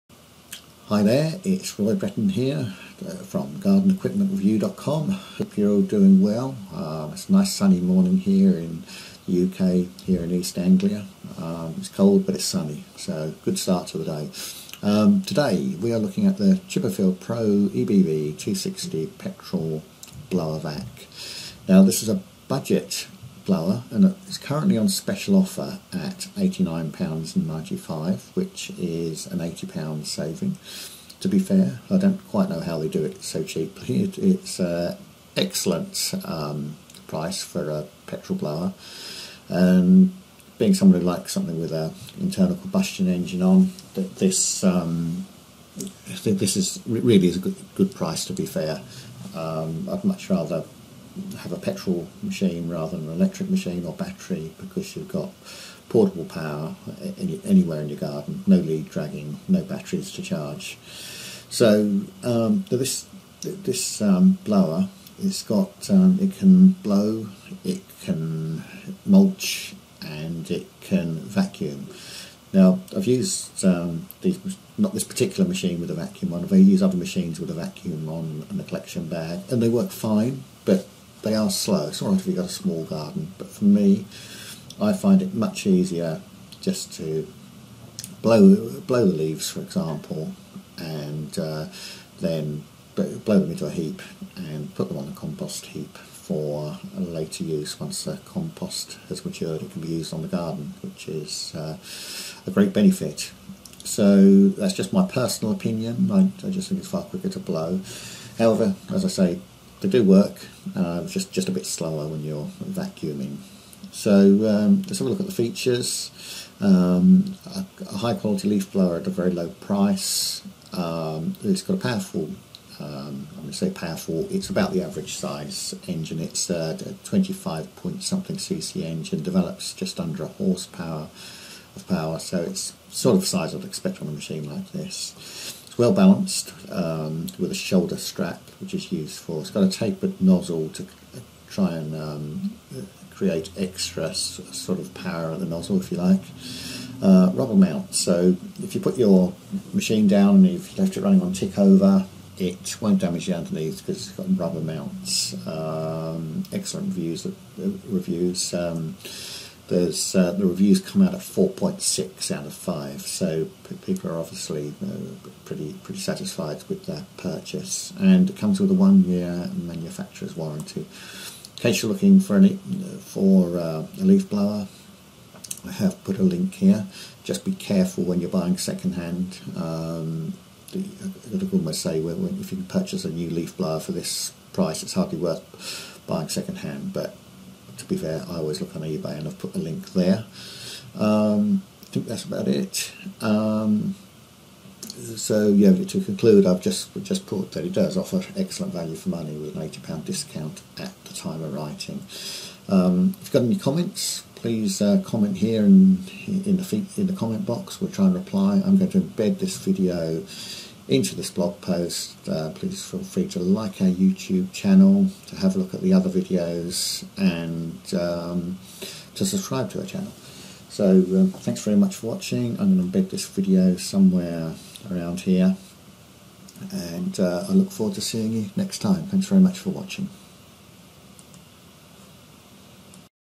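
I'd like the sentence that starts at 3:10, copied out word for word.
Um, I think that's about it.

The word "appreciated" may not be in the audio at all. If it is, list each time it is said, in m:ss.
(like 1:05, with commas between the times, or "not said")
not said.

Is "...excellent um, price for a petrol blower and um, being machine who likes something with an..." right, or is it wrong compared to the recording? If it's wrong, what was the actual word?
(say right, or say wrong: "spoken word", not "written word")
wrong: "someone", not "machine".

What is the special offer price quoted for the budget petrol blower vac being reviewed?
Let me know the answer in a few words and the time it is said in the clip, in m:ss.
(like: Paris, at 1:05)
£89.95, at 0:26.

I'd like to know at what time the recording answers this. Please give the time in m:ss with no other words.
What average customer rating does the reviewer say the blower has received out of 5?
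2:41.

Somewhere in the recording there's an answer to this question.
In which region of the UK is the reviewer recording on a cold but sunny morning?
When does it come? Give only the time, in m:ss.
0:10.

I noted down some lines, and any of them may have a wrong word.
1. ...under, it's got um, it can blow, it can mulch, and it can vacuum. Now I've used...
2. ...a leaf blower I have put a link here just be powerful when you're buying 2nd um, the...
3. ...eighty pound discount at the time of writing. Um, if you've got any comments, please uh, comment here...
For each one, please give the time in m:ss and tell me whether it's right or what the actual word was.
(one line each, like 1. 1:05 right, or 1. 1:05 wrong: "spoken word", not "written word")
1. 1:04 wrong: "blower", not "under"
2. 2:53 wrong: "careful", not "powerful"
3. 3:19 right.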